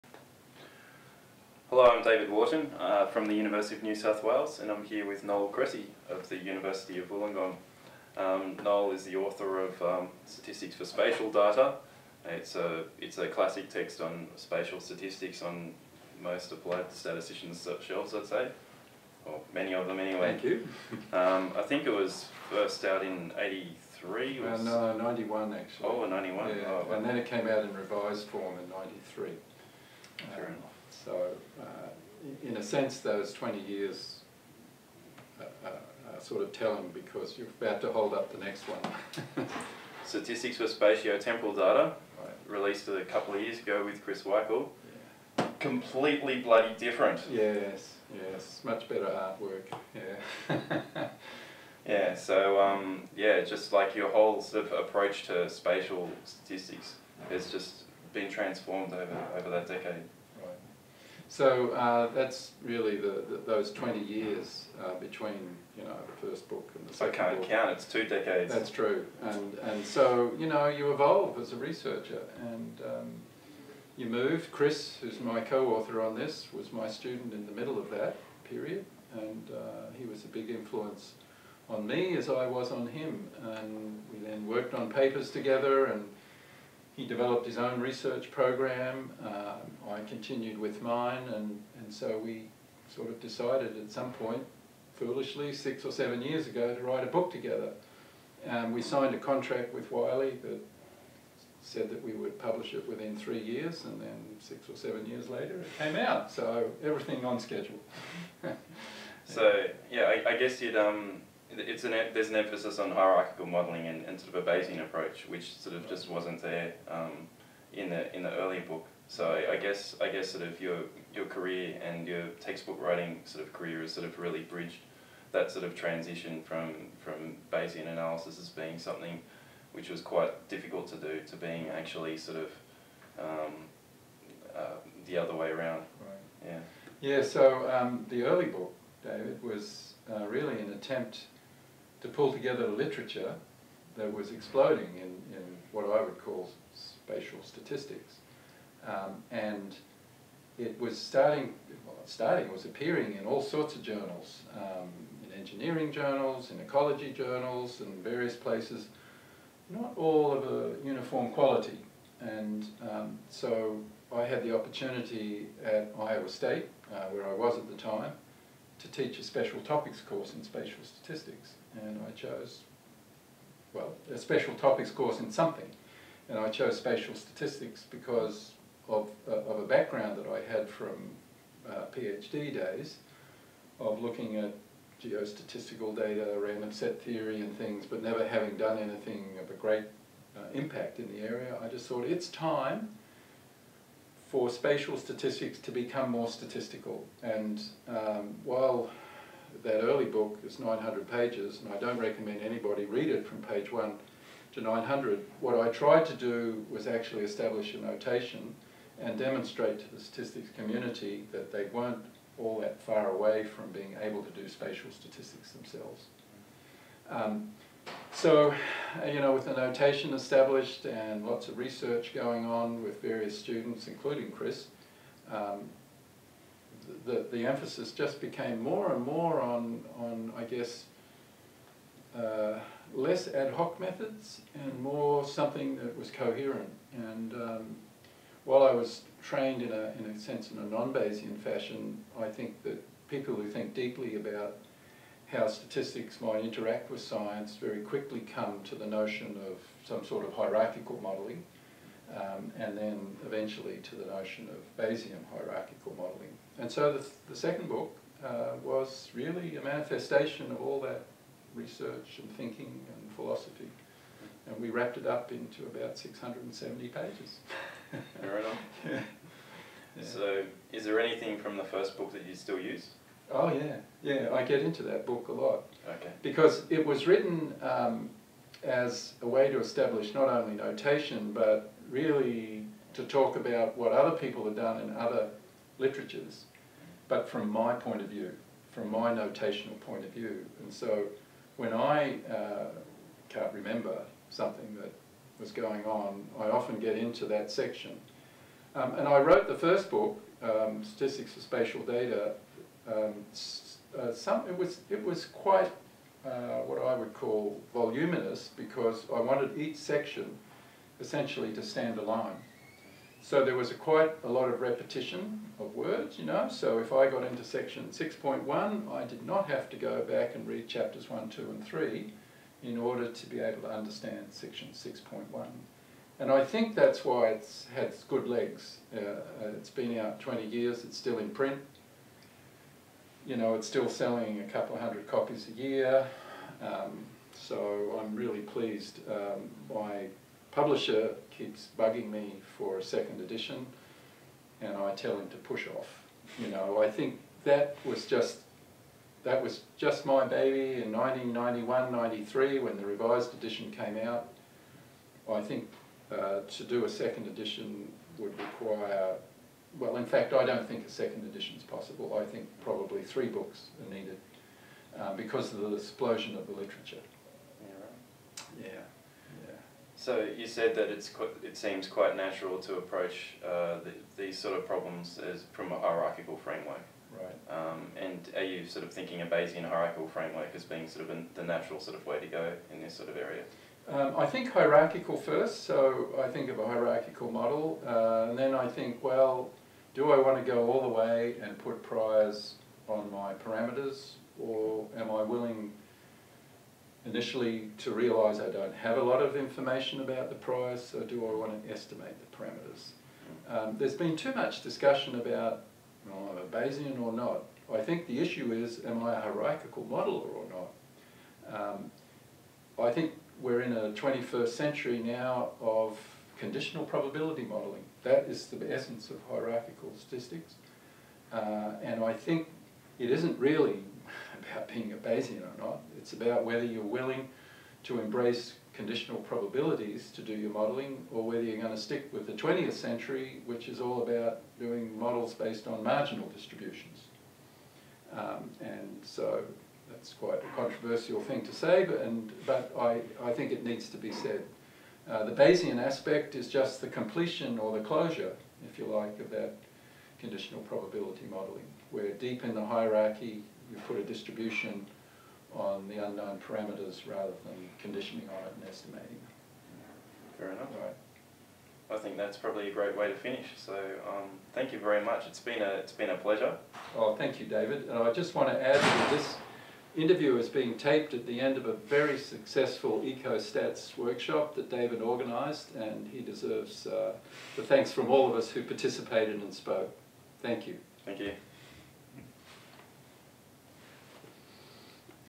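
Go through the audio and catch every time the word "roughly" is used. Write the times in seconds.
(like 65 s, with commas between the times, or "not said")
not said.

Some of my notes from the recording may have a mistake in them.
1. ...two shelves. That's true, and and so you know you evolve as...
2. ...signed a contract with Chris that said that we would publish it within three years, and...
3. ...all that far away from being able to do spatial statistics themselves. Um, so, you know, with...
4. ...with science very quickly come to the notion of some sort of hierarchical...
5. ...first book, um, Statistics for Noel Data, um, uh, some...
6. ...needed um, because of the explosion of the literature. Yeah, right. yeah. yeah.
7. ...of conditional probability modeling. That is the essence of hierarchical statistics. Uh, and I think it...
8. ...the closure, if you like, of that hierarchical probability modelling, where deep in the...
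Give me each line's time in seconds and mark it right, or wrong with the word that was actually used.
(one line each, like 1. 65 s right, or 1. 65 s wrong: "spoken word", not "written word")
1. 67 s wrong: "decades", not "shelves"
2. 98 s wrong: "Wiley", not "Chris"
3. 212 s right
4. 246 s right
5. 299 s wrong: "Spatial", not "Noel"
6. 363 s right
7. 415 s right
8. 447 s wrong: "conditional", not "hierarchical".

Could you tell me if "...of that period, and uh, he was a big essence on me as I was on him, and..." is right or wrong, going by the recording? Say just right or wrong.
wrong.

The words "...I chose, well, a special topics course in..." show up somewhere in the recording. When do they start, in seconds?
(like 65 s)
172 s.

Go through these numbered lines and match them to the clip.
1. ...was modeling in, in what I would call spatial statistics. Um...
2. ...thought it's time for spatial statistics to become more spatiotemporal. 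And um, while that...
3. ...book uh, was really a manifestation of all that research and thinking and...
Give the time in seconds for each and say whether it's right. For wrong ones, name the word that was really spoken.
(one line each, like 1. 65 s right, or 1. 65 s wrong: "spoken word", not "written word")
1. 144 s wrong: "exploding", not "modeling"
2. 191 s wrong: "statistical", not "spatiotemporal"
3. 257 s right.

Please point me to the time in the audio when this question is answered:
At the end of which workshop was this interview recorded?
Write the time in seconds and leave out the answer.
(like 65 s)
473 s.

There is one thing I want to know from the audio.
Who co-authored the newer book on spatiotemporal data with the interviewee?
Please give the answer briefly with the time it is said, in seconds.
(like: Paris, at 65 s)
Chris Wikle, at 44 s.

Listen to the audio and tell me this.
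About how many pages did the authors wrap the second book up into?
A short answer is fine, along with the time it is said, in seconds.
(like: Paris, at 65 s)
670, at 265 s.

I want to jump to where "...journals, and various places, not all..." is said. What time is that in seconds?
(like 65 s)
157 s.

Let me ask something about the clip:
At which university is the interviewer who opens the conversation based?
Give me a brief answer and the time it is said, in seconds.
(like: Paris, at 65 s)
University of New South Wales, at 3 s.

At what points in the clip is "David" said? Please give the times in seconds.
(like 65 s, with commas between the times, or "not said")
2 s, 139 s, 467 s, 474 s.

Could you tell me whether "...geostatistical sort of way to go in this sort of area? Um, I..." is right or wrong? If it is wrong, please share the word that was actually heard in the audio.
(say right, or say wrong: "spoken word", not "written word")
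wrong: "natural", not "geostatistical".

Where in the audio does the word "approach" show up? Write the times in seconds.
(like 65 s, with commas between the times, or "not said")
54 s, 114 s, 372 s.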